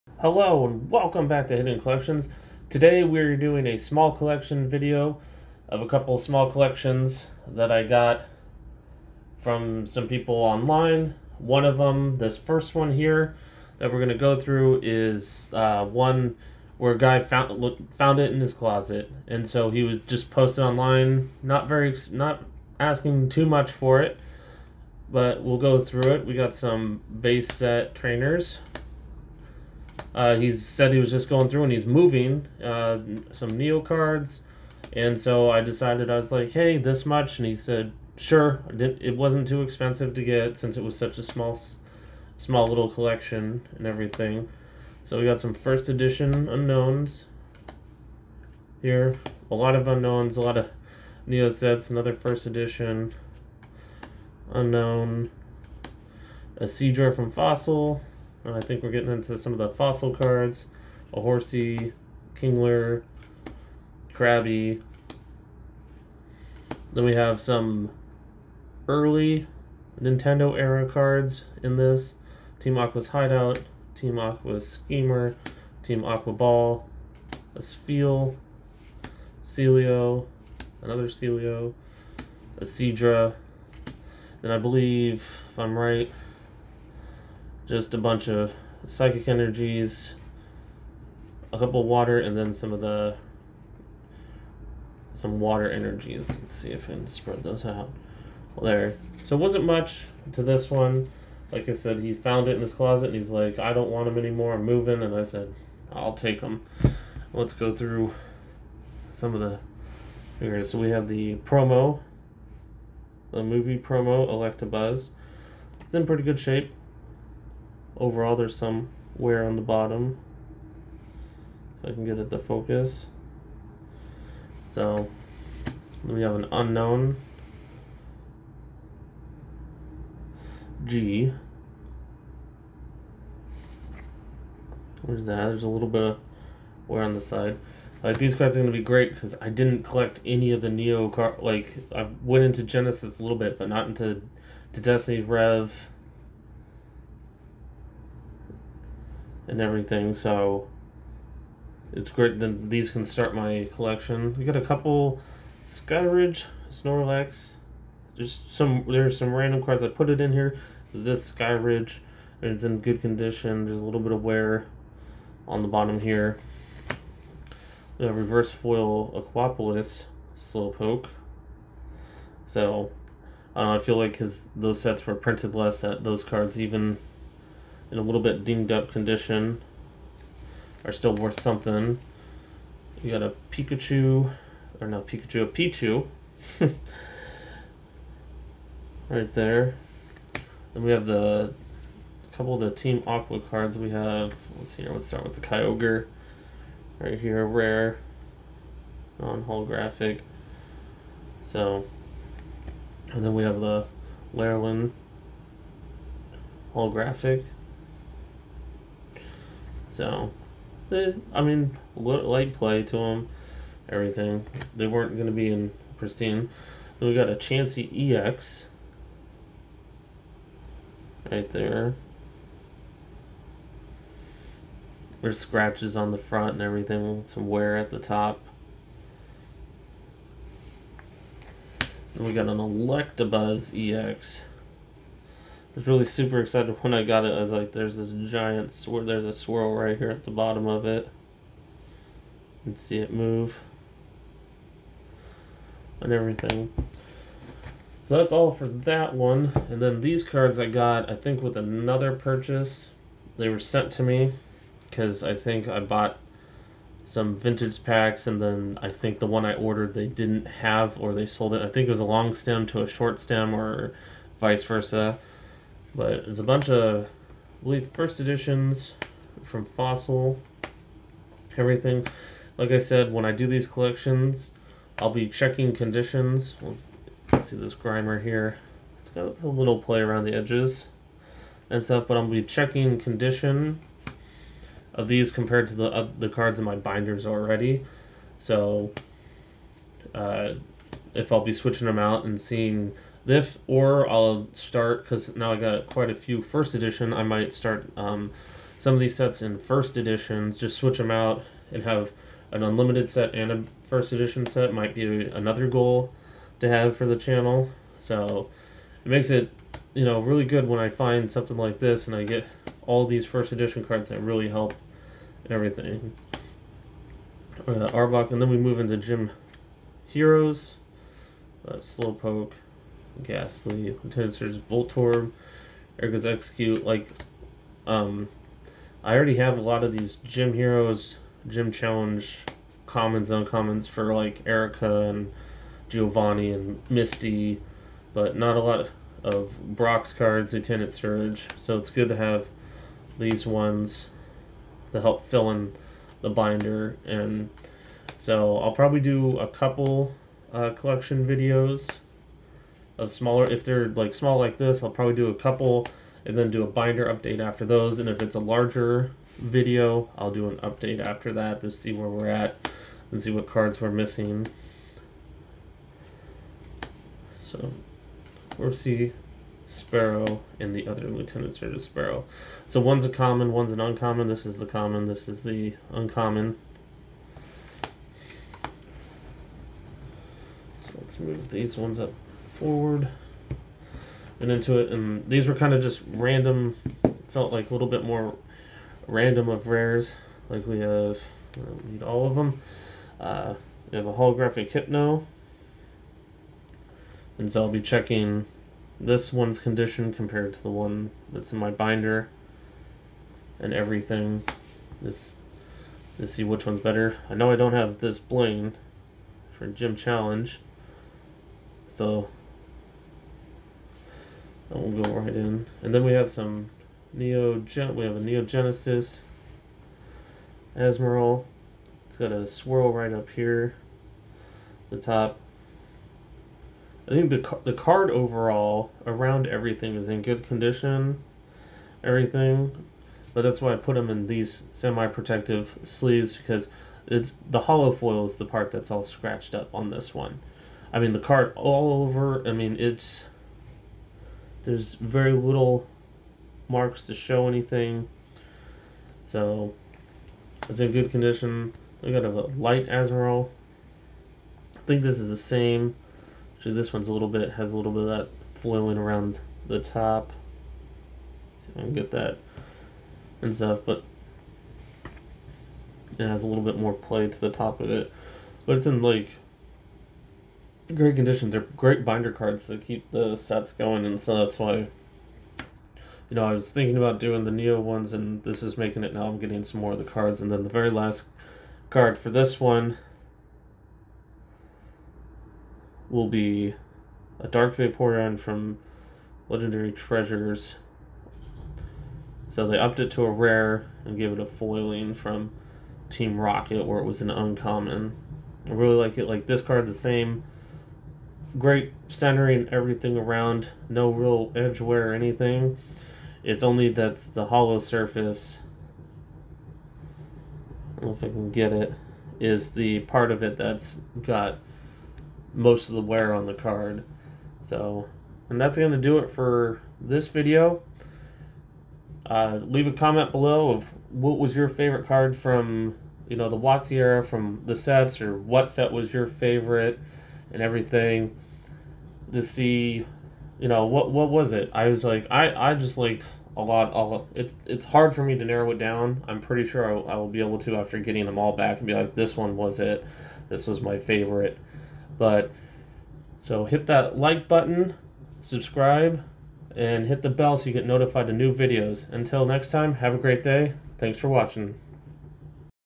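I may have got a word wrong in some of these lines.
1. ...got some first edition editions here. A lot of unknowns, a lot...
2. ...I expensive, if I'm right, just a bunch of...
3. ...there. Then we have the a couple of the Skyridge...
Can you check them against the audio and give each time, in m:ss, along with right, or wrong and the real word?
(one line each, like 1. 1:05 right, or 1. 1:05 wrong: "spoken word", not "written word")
1. 0:45 wrong: "unknowns", not "editions"
2. 1:24 wrong: "believe", not "expensive"
3. 3:09 wrong: "Team", not "Skyridge".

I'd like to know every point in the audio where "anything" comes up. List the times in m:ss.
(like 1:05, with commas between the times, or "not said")
7:27, 8:25.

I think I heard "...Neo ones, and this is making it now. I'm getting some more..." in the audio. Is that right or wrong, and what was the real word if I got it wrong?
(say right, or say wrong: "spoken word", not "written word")
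right.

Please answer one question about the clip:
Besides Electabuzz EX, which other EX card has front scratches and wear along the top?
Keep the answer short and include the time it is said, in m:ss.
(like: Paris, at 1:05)
Chansey EX, at 3:37.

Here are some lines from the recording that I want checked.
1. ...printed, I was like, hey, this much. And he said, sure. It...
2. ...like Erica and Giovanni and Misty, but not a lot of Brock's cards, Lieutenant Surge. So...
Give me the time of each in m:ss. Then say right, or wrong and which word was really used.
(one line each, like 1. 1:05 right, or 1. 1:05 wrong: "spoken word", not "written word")
1. 0:35 wrong: "decided", not "printed"
2. 5:34 right.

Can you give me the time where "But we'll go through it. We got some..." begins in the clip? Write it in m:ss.
0:25.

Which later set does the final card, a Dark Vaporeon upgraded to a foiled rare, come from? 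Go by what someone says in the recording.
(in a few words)
Legendary Treasures.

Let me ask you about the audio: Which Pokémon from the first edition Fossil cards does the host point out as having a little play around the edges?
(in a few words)
Grimer.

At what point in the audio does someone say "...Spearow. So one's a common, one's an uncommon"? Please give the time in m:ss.
6:11.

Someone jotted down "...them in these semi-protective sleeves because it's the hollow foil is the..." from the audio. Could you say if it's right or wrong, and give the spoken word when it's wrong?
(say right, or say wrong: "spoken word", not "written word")
right.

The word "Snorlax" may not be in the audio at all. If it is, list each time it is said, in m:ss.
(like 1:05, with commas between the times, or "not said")
2:36.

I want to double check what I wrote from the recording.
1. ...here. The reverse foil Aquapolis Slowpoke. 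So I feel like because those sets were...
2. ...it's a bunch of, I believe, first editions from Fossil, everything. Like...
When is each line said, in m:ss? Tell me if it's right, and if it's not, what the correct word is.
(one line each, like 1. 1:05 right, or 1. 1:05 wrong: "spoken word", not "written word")
1. 2:45 right
2. 4:26 right.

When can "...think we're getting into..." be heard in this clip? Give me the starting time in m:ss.
0:58.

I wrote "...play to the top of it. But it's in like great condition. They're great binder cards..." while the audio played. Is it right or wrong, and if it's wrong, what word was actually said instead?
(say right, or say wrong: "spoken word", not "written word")
right.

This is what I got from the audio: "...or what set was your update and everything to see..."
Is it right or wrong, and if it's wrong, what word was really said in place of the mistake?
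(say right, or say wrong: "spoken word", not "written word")
wrong: "favorite", not "update".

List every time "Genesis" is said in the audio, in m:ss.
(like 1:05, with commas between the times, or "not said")
2:22, 6:58.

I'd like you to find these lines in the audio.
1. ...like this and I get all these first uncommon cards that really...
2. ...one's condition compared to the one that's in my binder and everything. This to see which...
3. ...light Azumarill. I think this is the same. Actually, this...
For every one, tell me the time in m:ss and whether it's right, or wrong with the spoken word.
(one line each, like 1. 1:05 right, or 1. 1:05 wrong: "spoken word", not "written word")
1. 5:11 wrong: "edition", not "uncommon"
2. 6:39 right
3. 7:32 right.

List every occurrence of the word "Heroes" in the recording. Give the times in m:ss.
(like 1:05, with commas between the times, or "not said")
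5:20, 5:30.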